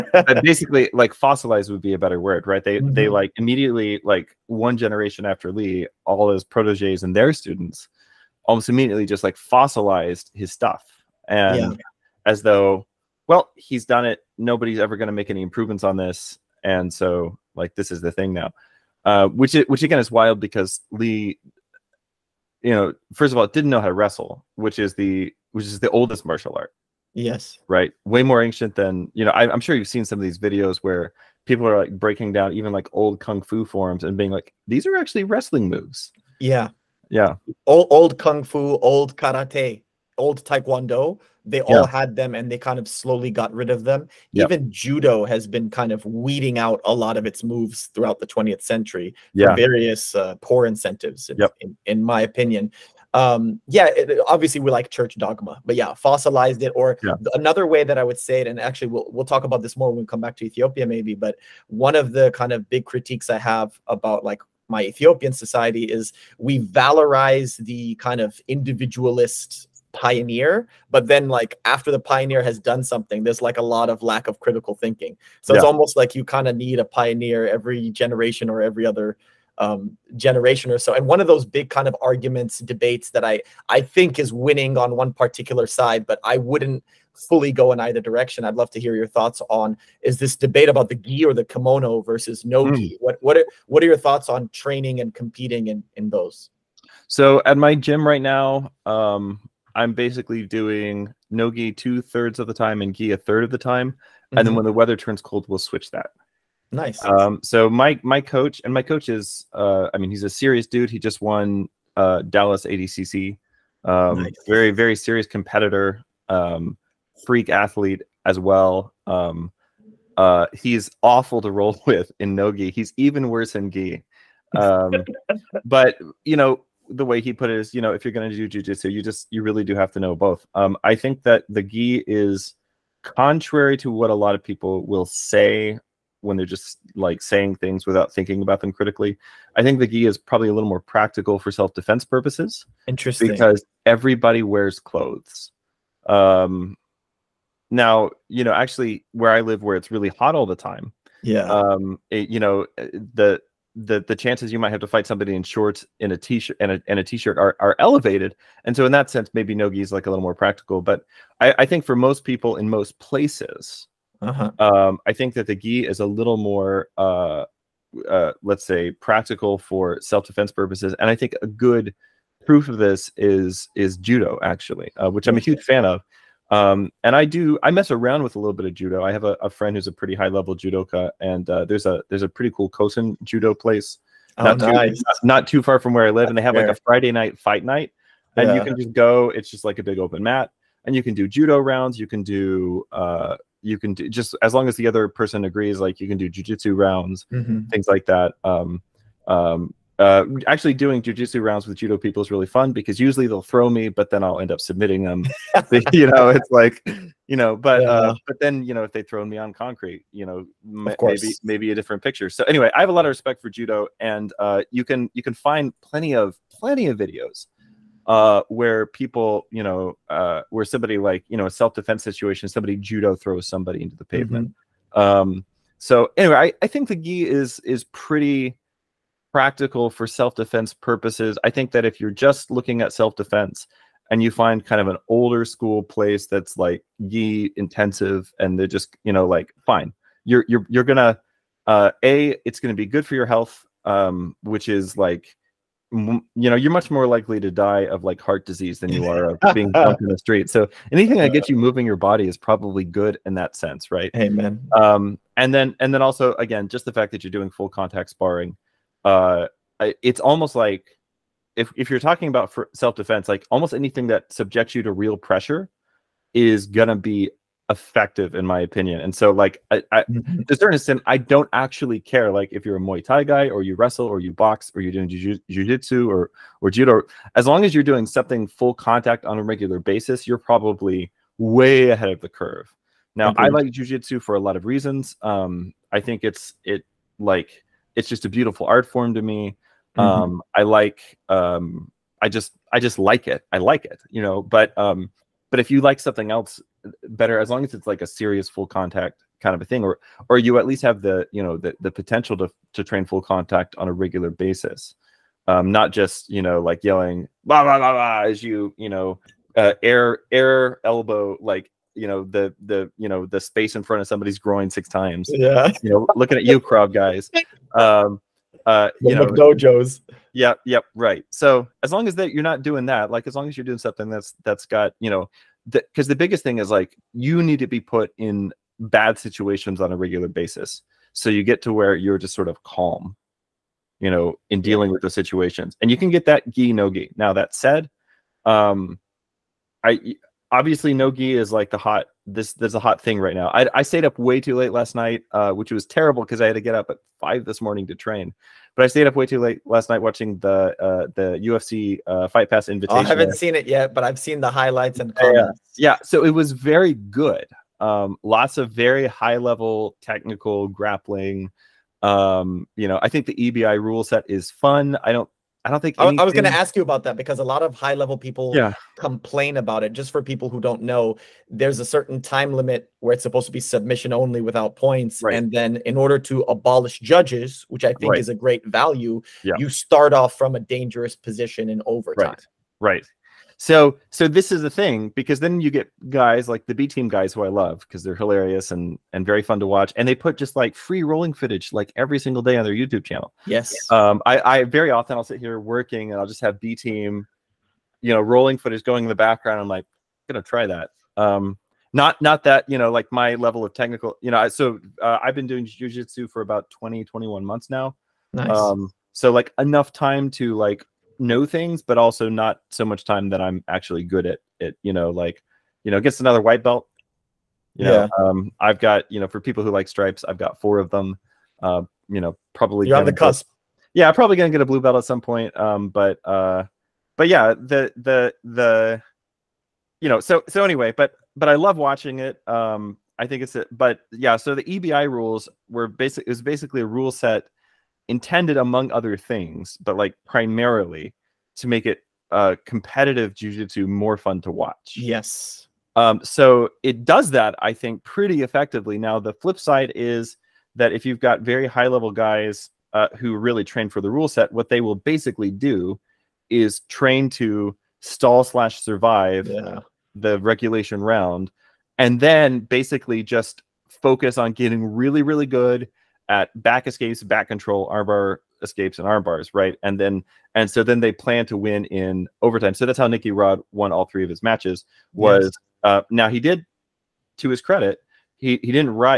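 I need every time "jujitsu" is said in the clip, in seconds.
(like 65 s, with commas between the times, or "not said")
128 s, 196 s, 201 s, 443 s.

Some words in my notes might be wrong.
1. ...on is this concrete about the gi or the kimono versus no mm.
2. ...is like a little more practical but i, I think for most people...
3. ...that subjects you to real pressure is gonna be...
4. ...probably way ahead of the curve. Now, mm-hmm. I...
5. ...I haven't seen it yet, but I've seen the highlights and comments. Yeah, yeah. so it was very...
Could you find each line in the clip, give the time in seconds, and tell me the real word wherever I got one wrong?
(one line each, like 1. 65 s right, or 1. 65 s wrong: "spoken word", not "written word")
1. 89 s wrong: "debate", not "concrete"
2. 159 s right
3. 264 s right
4. 280 s right
5. 353 s right.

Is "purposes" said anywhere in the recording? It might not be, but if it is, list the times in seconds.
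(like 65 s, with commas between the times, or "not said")
142 s, 170 s, 230 s.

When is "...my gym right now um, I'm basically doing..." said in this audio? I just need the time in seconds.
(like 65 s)
97 s.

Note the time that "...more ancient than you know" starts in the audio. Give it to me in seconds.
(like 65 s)
28 s.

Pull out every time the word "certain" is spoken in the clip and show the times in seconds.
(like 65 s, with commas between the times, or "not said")
270 s, 371 s.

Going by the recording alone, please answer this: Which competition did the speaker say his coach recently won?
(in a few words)
Dallas ADCC.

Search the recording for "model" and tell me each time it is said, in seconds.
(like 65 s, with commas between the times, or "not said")
not said.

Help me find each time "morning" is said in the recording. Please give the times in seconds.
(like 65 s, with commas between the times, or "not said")
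347 s.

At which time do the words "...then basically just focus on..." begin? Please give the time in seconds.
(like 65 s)
462 s.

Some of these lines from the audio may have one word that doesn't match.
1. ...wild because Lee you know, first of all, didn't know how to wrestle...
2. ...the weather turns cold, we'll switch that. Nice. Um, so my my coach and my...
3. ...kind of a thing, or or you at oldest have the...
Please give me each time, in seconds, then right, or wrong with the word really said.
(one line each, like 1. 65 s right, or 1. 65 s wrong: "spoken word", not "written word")
1. 20 s right
2. 104 s right
3. 299 s wrong: "least", not "oldest".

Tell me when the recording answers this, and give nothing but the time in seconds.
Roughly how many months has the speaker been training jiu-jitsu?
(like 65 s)
407 s.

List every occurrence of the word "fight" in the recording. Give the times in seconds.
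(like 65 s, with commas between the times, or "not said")
154 s, 187 s, 352 s.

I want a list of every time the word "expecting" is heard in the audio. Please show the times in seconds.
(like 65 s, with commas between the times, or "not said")
not said.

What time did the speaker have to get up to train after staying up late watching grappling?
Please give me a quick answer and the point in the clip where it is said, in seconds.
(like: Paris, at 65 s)
5, at 347 s.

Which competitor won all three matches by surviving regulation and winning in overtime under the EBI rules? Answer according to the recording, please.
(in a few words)
Nicky Rod.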